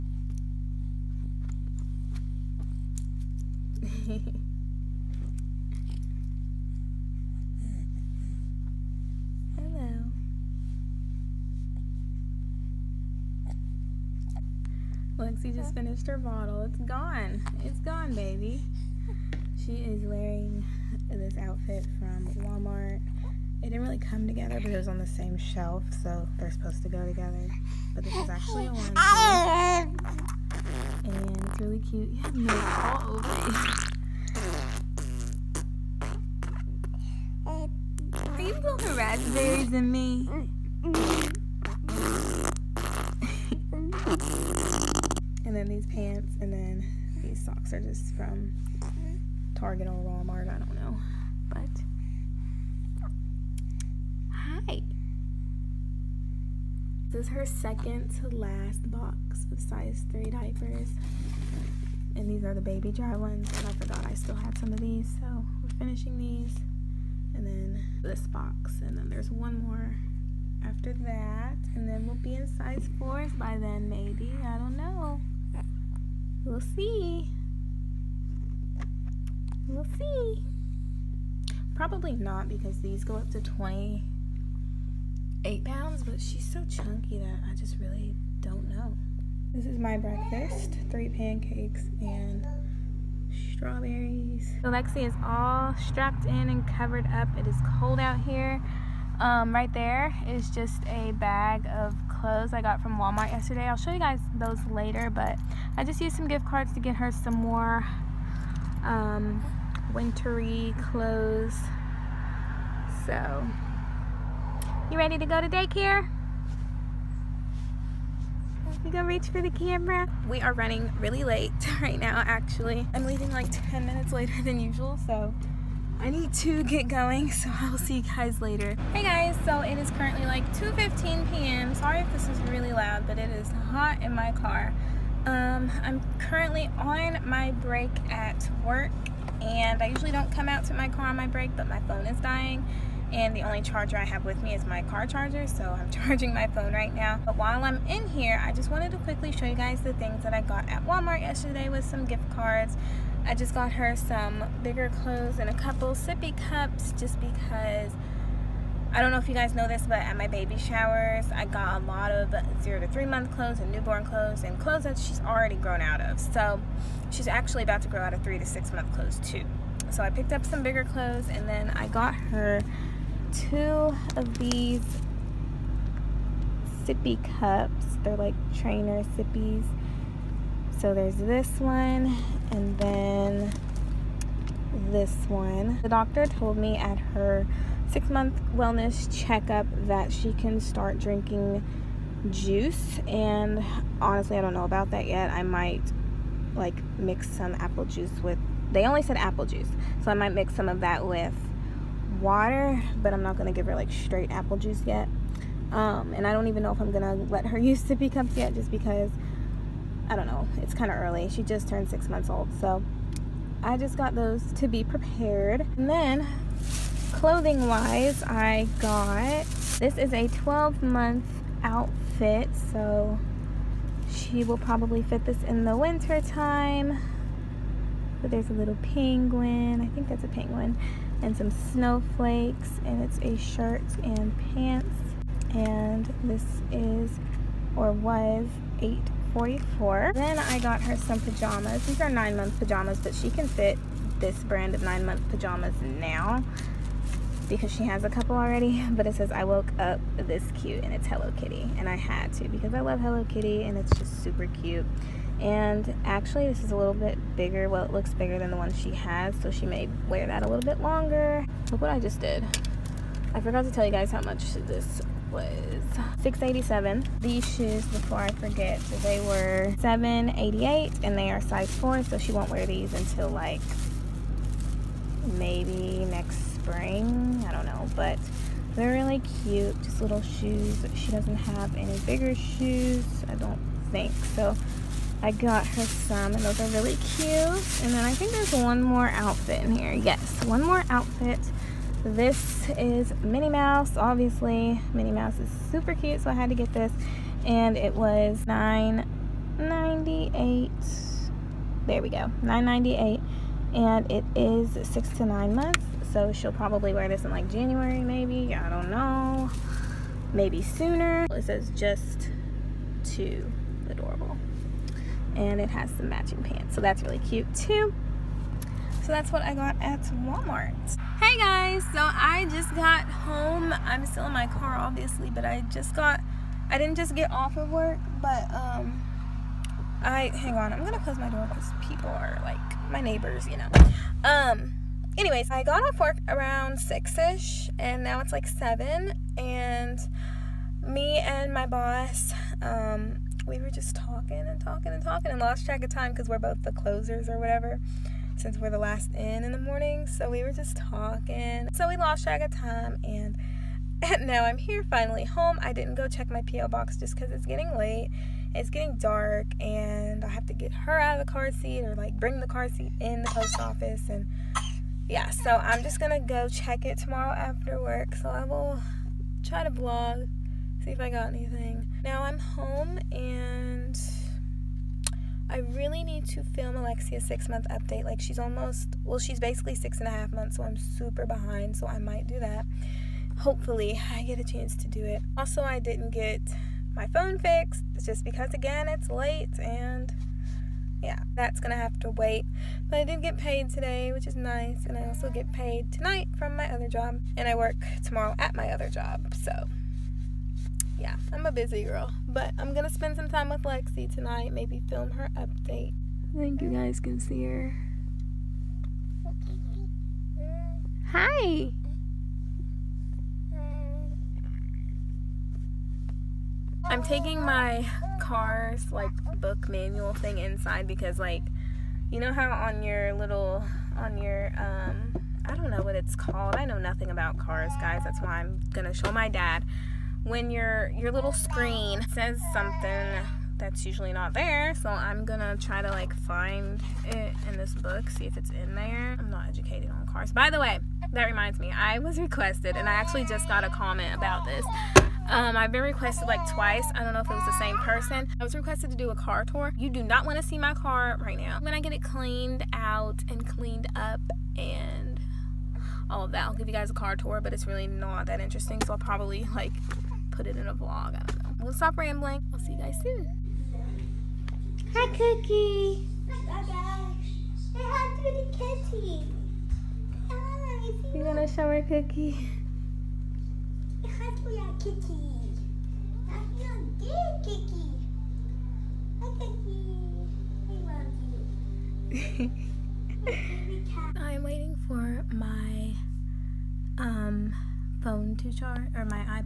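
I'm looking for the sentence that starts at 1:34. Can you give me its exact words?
Alexi is all strapped in and covered up.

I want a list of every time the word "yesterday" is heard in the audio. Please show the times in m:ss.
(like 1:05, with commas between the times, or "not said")
1:43, 2:31.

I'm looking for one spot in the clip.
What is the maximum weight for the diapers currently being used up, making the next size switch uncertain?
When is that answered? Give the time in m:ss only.
1:23.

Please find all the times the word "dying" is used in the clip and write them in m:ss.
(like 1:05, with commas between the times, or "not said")
2:22.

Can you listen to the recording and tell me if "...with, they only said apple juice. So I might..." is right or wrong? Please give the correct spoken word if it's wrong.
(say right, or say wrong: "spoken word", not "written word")
right.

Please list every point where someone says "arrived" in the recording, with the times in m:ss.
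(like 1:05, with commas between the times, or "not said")
not said.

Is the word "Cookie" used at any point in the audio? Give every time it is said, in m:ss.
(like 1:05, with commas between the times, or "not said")
7:45, 7:51.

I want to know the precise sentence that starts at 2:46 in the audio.
So she's actually about to grow out of three to six month clothes too.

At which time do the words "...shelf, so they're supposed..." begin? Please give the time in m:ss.
0:25.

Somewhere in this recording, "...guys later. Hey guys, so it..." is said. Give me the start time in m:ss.
2:08.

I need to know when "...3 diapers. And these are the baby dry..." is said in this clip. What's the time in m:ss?
1:00.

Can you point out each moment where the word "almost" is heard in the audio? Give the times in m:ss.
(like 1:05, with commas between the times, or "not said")
6:18.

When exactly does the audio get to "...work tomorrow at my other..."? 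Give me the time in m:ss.
6:37.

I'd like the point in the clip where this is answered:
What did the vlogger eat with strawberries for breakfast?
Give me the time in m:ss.
1:30.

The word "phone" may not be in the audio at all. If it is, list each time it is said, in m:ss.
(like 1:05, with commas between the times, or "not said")
2:21, 2:26, 6:27.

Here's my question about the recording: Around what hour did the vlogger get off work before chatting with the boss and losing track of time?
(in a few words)
6.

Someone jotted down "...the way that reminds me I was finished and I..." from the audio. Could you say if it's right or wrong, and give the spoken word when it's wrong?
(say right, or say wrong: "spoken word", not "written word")
wrong: "requested", not "finished".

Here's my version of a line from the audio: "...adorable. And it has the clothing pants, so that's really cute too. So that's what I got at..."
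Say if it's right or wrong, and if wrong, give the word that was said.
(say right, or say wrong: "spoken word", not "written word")
wrong: "matching", not "clothing".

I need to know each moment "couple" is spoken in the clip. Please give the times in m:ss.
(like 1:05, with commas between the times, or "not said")
2:35, 4:08.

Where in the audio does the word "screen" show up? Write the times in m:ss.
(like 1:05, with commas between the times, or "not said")
7:11.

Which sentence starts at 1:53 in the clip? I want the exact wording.
So, you ready to go to daycare?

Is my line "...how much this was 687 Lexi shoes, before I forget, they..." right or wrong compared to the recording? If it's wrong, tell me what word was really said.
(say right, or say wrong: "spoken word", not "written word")
wrong: "These", not "Lexi".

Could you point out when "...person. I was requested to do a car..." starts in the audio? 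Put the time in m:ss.
7:27.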